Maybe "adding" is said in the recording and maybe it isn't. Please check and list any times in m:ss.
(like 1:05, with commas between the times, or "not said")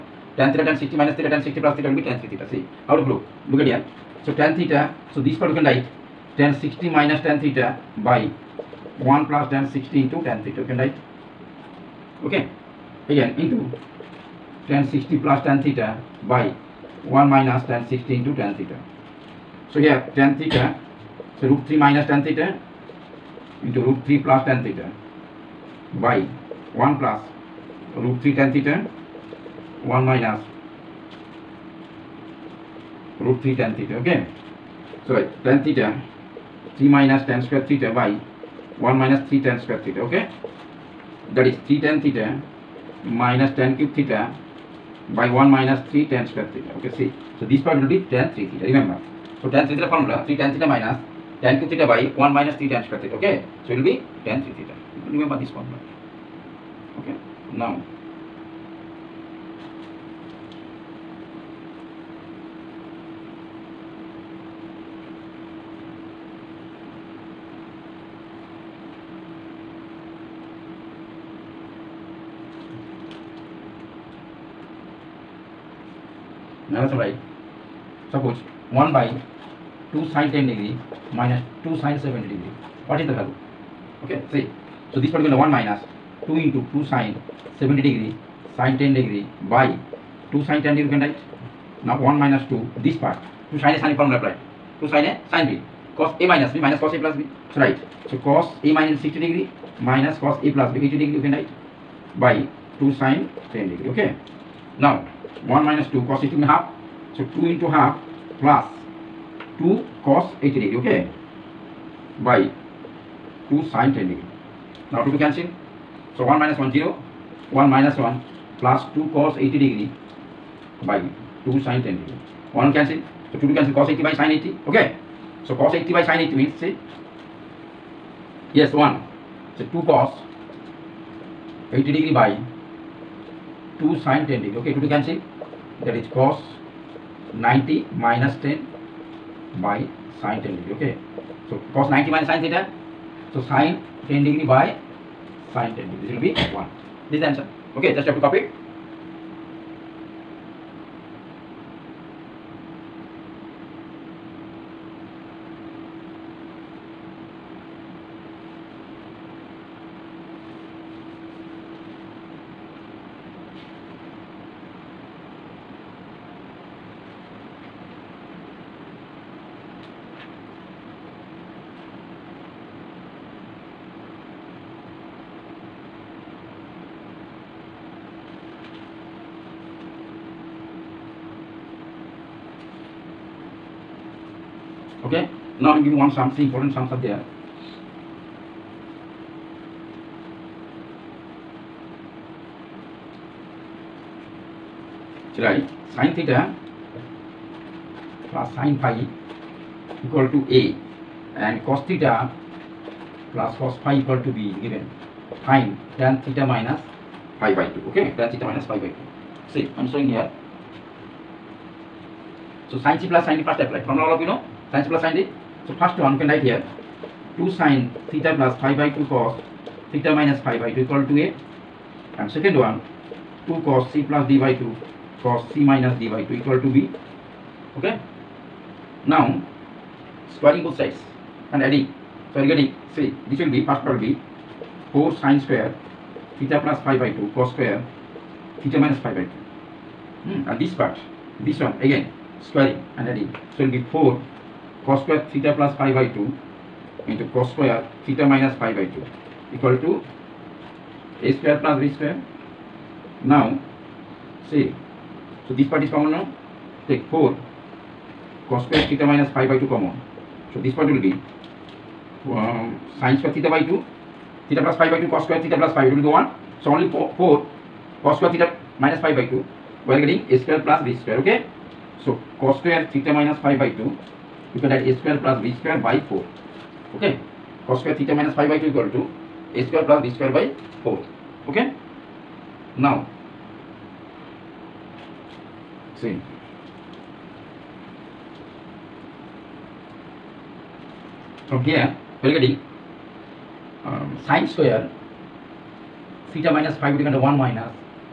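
3:51, 4:03.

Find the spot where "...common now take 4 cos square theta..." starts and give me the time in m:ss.
4:15.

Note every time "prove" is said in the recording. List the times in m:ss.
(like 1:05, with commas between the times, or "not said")
0:03.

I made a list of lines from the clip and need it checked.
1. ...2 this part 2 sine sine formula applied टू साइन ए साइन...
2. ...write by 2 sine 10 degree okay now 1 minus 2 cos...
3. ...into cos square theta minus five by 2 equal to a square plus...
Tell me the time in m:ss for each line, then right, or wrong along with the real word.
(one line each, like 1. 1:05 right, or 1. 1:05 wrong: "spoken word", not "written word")
1. 1:32 right
2. 1:41 right
3. 4:07 right.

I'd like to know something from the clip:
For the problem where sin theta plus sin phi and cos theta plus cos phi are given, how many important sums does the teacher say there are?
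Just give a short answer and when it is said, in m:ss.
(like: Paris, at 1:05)
3, at 3:06.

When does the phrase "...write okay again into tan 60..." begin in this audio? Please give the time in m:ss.
0:10.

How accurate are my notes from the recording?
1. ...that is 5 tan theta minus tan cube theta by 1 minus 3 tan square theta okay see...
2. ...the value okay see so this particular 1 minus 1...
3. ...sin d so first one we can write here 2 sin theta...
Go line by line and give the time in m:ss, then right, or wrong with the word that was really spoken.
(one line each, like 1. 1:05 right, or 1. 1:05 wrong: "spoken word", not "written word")
1. 0:41 wrong: "3", not "5"
2. 1:23 wrong: "2", not "1"
3. 3:35 right.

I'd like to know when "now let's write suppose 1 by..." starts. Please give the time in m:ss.
1:16.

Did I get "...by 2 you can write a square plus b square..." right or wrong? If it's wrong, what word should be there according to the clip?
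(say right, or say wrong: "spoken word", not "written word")
right.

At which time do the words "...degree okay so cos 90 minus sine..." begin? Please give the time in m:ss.
2:20.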